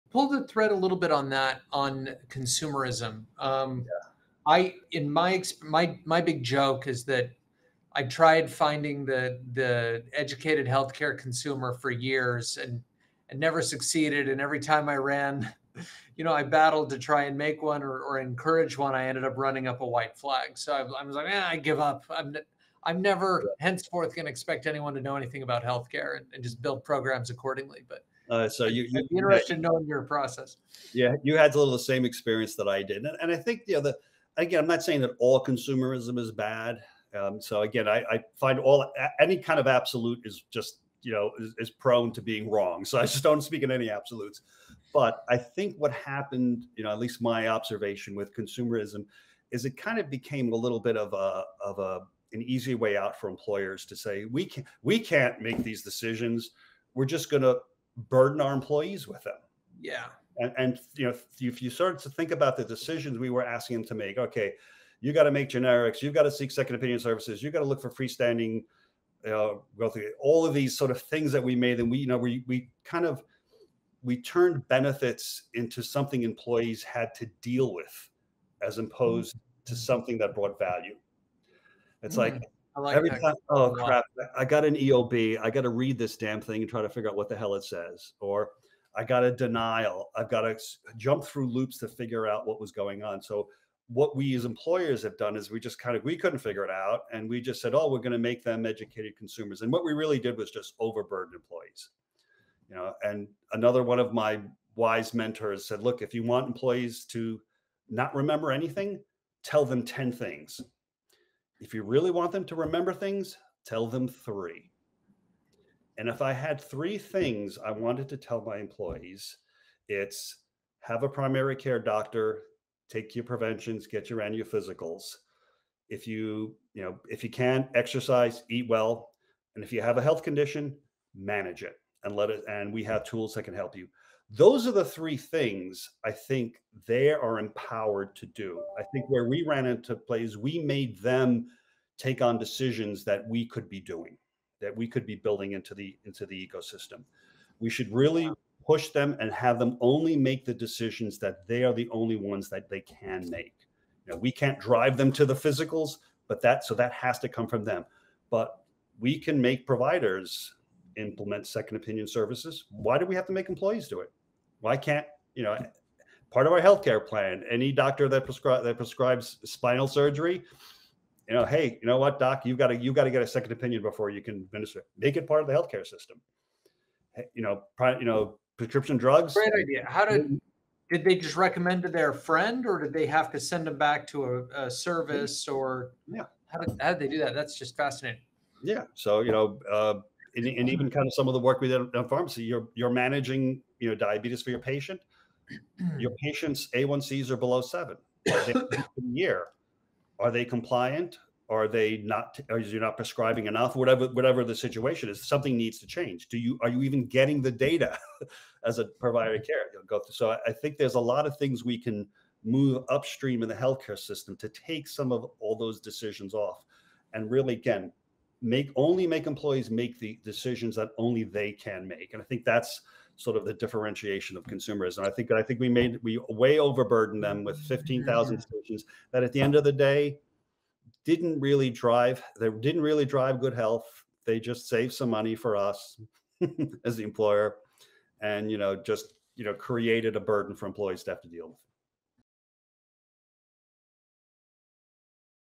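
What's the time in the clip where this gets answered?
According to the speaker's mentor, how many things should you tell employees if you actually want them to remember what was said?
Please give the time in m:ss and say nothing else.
1:53.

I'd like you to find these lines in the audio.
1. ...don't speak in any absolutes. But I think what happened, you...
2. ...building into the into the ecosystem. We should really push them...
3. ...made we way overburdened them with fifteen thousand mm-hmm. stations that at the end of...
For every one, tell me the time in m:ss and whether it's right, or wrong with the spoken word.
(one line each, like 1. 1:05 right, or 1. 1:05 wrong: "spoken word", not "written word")
1. 0:43 right
2. 2:25 right
3. 3:45 right.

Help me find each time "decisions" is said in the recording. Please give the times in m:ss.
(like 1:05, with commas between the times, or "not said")
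0:55, 1:02, 2:22, 2:30, 3:35, 3:40.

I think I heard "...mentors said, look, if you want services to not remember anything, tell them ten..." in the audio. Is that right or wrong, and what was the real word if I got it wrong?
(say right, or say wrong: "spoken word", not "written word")
wrong: "employees", not "services".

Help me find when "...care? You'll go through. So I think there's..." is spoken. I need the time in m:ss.
3:29.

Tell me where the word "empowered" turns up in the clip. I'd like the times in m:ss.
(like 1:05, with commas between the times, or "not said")
2:17.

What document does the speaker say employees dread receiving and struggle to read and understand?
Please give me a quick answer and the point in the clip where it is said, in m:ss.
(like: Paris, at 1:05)
EOB, at 1:24.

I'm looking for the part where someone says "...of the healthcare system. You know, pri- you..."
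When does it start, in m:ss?
2:55.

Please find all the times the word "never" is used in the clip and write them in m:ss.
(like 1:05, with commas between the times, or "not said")
0:13, 0:22.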